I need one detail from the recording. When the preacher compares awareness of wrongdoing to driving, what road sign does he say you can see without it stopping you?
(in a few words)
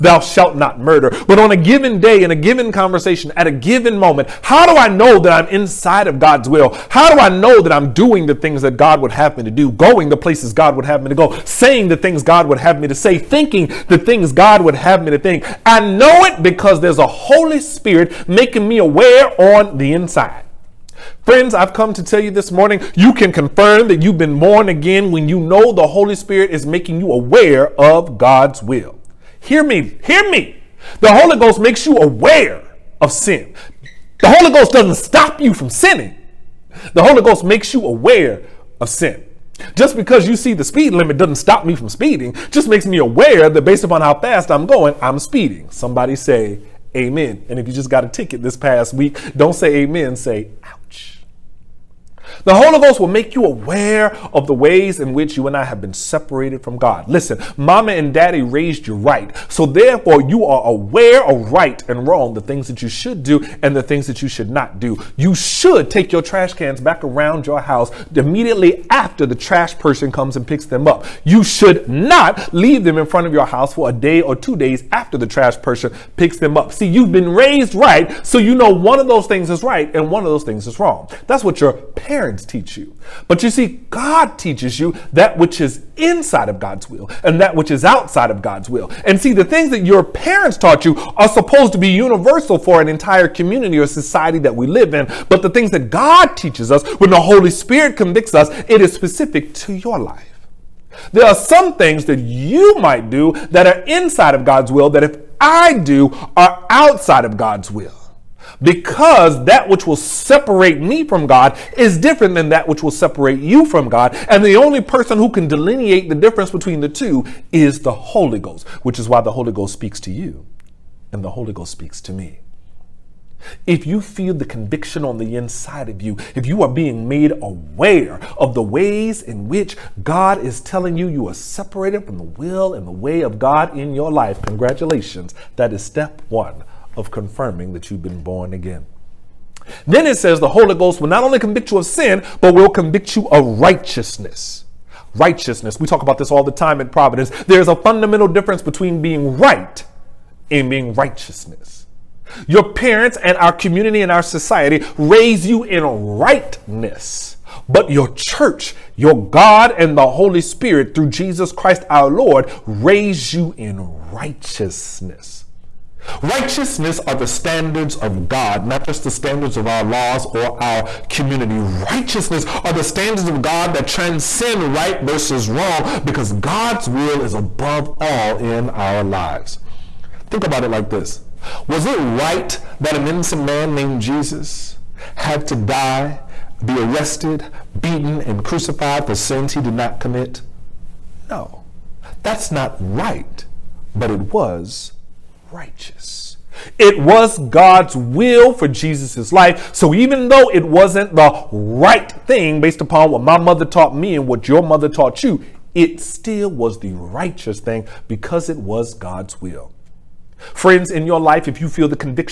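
speed limit.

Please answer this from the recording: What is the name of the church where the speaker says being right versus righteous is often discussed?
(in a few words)
Providence.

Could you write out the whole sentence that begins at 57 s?
Listen, mama and daddy raised you right.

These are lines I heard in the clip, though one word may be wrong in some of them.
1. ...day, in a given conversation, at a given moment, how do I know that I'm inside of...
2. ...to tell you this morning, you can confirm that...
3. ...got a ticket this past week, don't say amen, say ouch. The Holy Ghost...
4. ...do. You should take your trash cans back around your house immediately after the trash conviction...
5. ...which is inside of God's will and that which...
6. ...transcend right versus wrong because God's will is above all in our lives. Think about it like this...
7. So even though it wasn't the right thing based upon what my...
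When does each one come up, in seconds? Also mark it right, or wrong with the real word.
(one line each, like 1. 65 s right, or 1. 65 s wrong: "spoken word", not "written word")
1. 2 s right
2. 21 s right
3. 47 s right
4. 64 s wrong: "person", not "conviction"
5. 85 s right
6. 173 s right
7. 199 s right.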